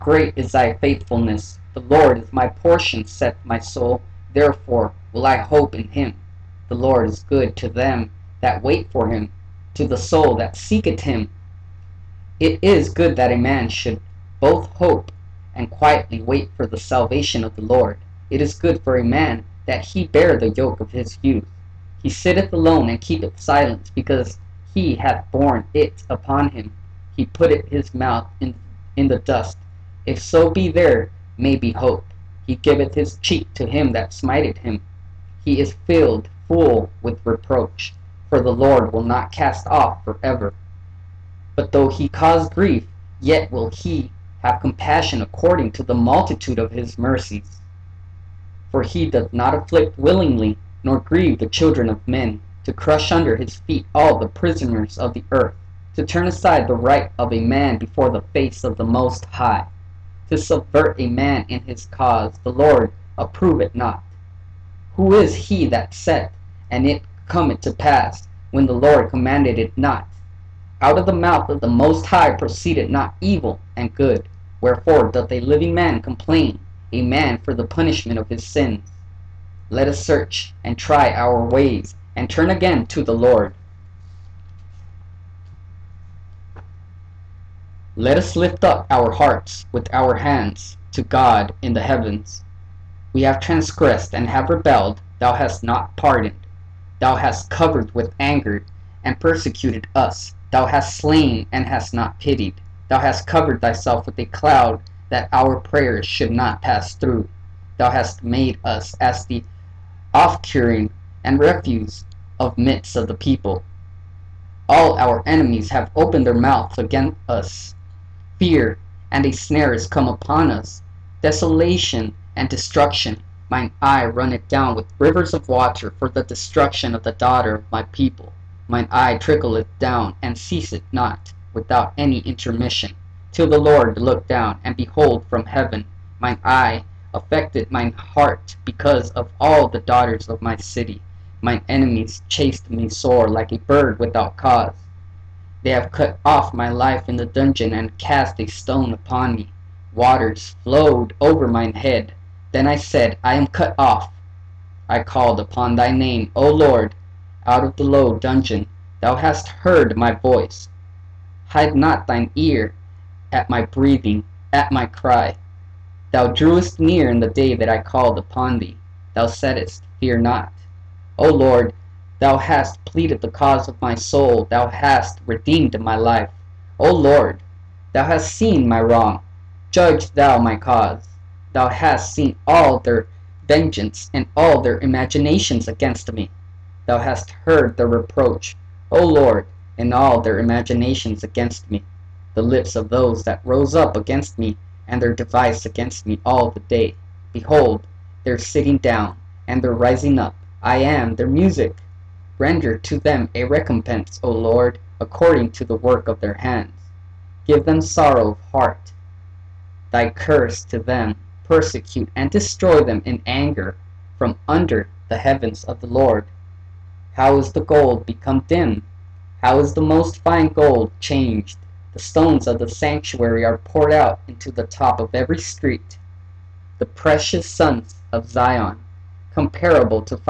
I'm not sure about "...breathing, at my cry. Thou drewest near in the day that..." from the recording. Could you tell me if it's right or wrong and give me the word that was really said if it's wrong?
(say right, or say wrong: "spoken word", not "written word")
right.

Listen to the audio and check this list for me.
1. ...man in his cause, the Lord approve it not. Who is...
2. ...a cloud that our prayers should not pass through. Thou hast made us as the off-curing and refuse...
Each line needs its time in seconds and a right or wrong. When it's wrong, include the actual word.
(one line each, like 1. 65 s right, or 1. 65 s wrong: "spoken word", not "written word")
1. 61 s right
2. 104 s right.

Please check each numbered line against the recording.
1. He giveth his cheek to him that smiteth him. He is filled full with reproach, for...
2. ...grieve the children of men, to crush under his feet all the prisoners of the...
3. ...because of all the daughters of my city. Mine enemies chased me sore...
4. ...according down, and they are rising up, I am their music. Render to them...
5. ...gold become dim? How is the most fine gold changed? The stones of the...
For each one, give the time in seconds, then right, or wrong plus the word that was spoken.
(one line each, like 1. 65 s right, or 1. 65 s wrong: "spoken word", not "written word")
1. 32 s right
2. 50 s right
3. 138 s right
4. 198 s wrong: "sitting", not "according"
5. 217 s right.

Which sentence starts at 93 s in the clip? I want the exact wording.
We have transgressed and have rebelled, thou hast not pardoned.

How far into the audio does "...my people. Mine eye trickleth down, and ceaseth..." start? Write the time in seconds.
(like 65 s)
127 s.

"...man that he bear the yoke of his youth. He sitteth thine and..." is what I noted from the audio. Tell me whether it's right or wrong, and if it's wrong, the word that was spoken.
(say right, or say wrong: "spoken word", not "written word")
wrong: "alone", not "thine".